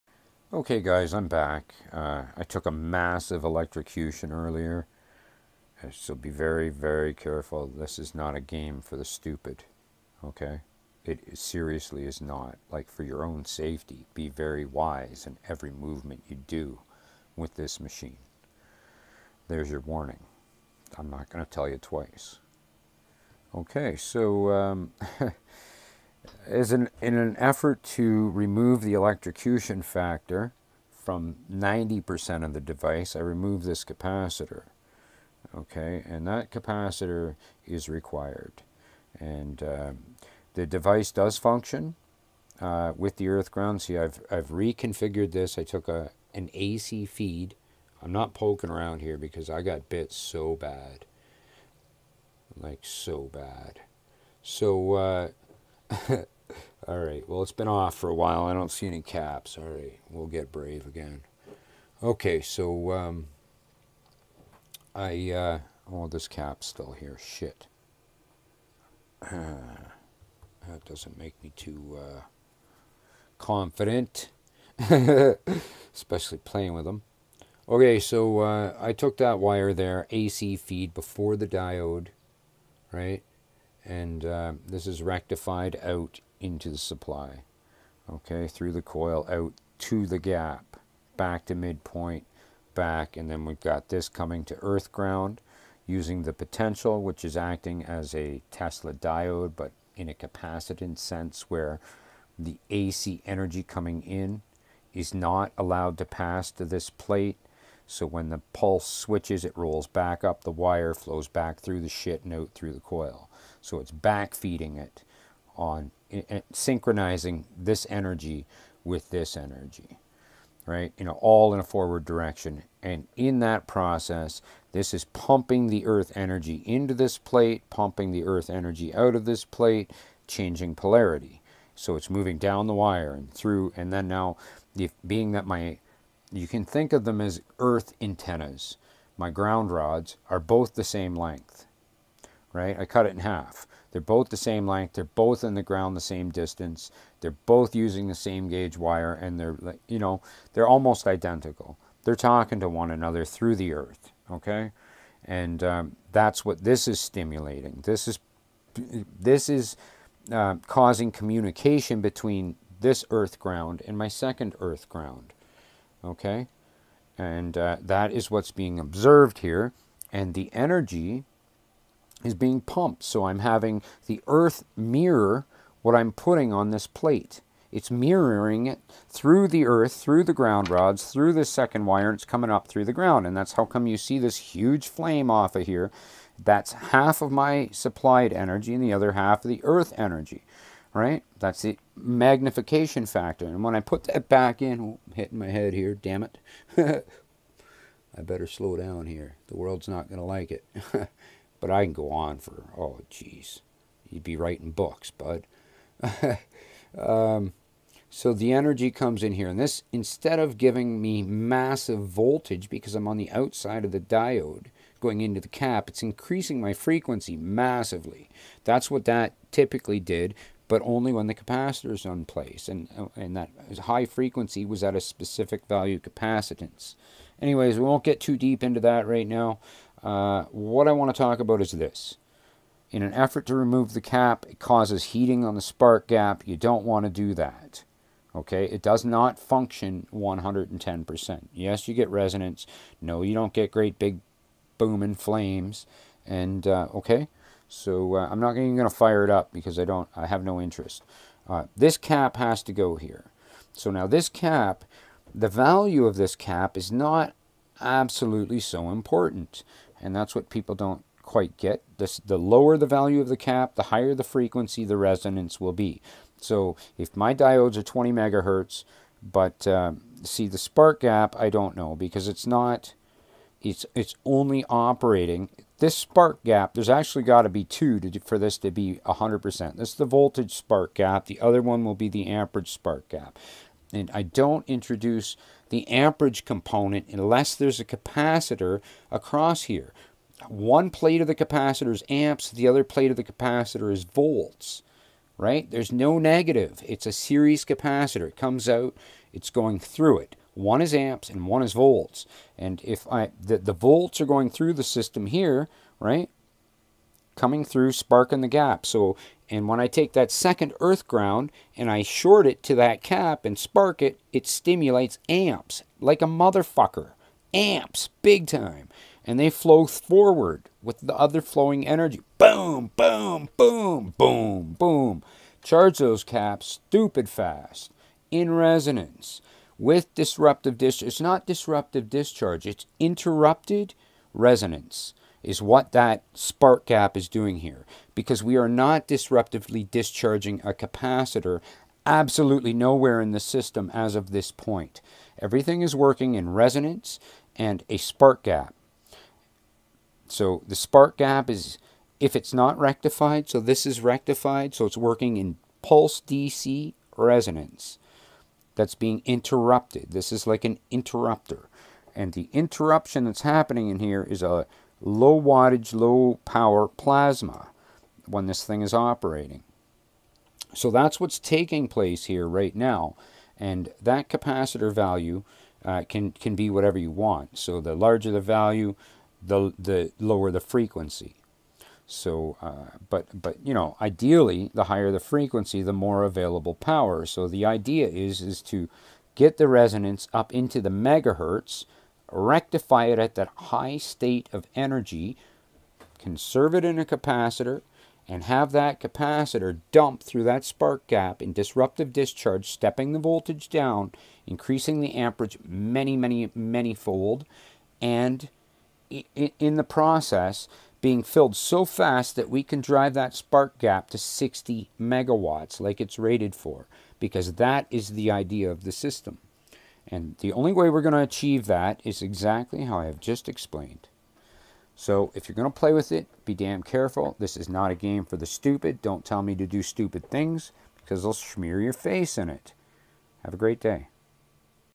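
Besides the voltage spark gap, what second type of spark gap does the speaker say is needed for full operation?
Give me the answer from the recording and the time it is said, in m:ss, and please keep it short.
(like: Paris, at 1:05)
amperage spark gap, at 4:42.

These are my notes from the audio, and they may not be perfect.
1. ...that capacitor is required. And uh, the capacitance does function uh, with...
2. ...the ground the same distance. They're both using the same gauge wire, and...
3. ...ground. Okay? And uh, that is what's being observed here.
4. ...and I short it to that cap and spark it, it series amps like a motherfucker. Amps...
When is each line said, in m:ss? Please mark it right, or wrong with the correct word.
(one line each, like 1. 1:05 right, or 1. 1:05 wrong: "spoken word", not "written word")
1. 0:36 wrong: "device", not "capacitance"
2. 2:25 right
3. 2:44 right
4. 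5:11 wrong: "stimulates", not "series".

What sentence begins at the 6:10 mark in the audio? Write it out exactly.
So that's what's taking place here right now.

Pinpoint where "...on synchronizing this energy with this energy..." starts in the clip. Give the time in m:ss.
1:55.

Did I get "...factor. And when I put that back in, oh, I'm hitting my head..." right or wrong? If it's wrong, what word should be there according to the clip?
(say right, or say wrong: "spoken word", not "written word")
right.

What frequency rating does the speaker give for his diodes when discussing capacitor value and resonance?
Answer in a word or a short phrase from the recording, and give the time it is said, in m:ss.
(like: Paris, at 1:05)
20 megahertz, at 4:27.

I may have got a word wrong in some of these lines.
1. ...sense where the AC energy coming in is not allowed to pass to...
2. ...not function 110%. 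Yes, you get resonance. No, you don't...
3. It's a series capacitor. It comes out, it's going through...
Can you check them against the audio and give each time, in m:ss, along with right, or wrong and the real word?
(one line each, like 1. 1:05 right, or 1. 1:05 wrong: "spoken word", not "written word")
1. 1:40 right
2. 3:59 right
3. 4:56 right.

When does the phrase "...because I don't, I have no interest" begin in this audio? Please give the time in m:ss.
4:09.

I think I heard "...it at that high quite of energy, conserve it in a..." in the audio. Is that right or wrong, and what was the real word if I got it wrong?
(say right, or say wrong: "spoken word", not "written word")
wrong: "state", not "quite".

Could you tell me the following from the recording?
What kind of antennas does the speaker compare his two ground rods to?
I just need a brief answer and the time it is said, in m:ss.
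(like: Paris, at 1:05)
earth antennas, at 2:17.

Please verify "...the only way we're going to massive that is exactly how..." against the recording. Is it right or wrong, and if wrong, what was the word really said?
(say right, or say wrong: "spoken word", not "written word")
wrong: "achieve", not "massive".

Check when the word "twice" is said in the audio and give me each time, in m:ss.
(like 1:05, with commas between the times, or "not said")
0:21.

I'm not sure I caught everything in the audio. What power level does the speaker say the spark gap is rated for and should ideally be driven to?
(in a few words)
60 megawatts.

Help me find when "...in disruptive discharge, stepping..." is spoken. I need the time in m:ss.
6:41.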